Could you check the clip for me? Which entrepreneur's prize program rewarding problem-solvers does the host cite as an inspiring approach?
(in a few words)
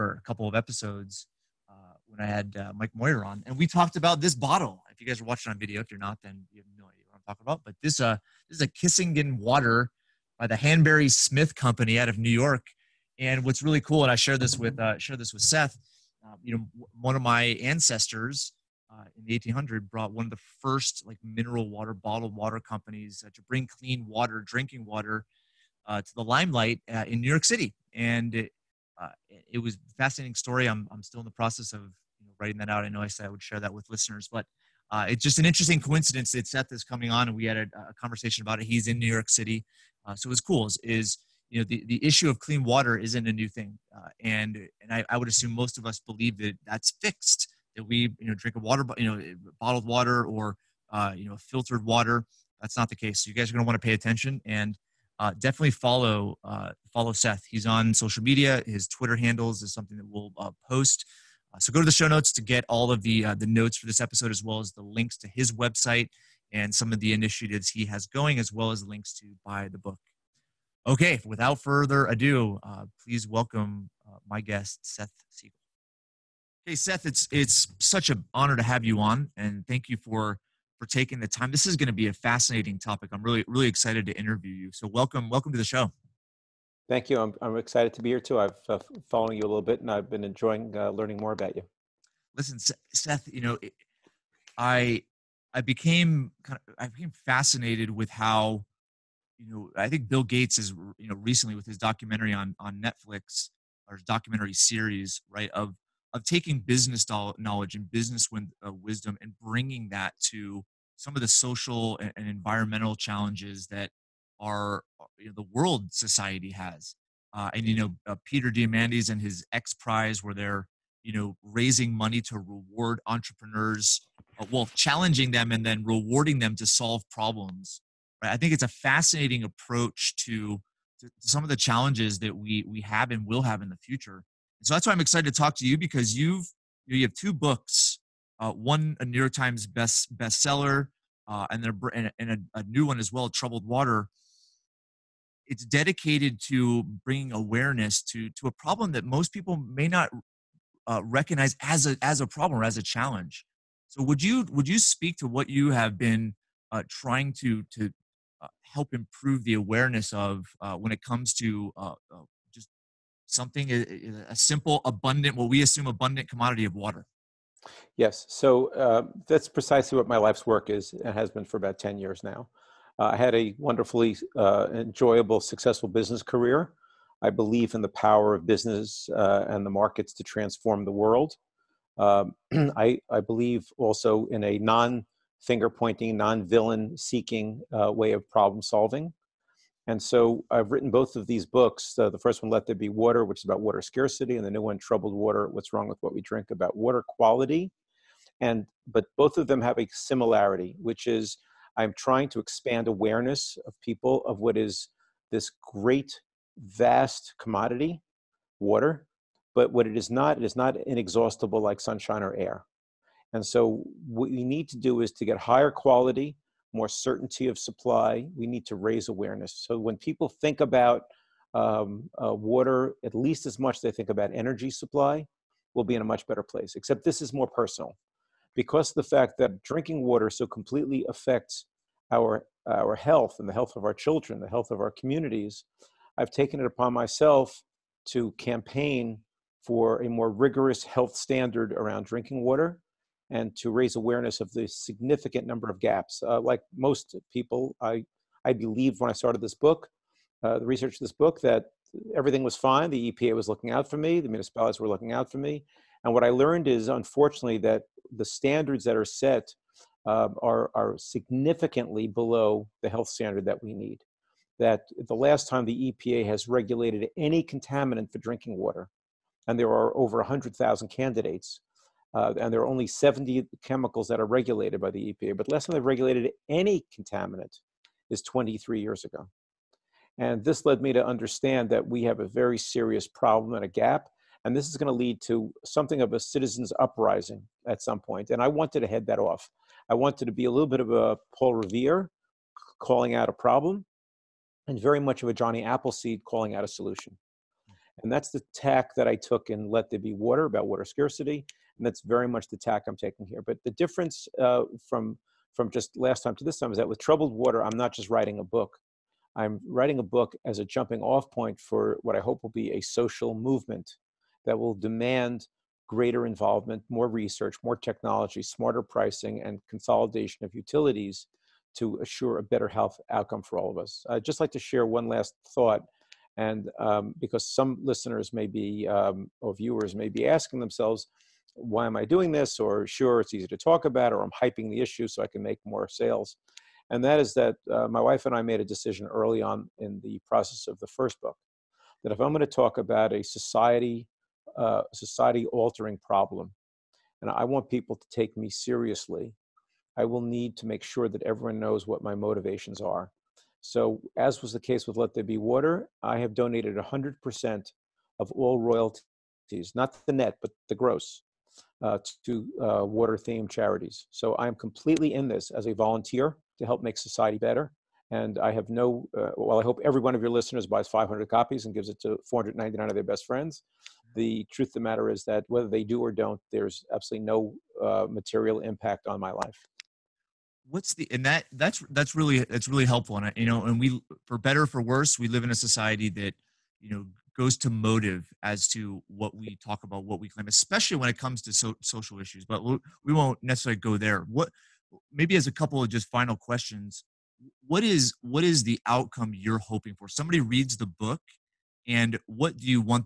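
Peter Diamandis.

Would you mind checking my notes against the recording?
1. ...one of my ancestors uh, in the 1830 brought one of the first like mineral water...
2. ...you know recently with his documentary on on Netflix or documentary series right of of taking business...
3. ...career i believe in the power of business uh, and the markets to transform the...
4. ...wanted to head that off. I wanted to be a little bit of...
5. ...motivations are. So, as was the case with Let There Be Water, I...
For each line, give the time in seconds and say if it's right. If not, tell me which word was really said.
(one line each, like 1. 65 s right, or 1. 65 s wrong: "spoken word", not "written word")
1. 17 s wrong: "1800", not "1830"
2. 100 s right
3. 176 s right
4. 288 s right
5. 352 s right.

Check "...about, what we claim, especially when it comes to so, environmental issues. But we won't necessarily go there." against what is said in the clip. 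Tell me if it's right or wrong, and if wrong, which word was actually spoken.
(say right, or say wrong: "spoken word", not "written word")
wrong: "social", not "environmental".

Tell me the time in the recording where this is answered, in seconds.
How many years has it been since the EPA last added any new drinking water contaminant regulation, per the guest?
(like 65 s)
278 s.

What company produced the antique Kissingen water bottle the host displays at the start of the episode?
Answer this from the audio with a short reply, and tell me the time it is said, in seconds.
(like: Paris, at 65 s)
Hanbury Smith Company, at 10 s.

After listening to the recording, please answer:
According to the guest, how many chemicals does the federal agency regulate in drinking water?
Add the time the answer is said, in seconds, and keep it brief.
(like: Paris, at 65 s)
70, at 272 s.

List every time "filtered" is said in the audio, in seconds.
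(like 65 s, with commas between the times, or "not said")
51 s.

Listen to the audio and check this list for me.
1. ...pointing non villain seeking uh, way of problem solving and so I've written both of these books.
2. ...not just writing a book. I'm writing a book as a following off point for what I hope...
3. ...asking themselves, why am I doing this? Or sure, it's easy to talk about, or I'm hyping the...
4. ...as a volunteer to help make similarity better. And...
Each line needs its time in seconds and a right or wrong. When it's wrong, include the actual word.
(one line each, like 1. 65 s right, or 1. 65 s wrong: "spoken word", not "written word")
1. 185 s right
2. 307 s wrong: "jumping", not "following"
3. 330 s right
4. 365 s wrong: "society", not "similarity".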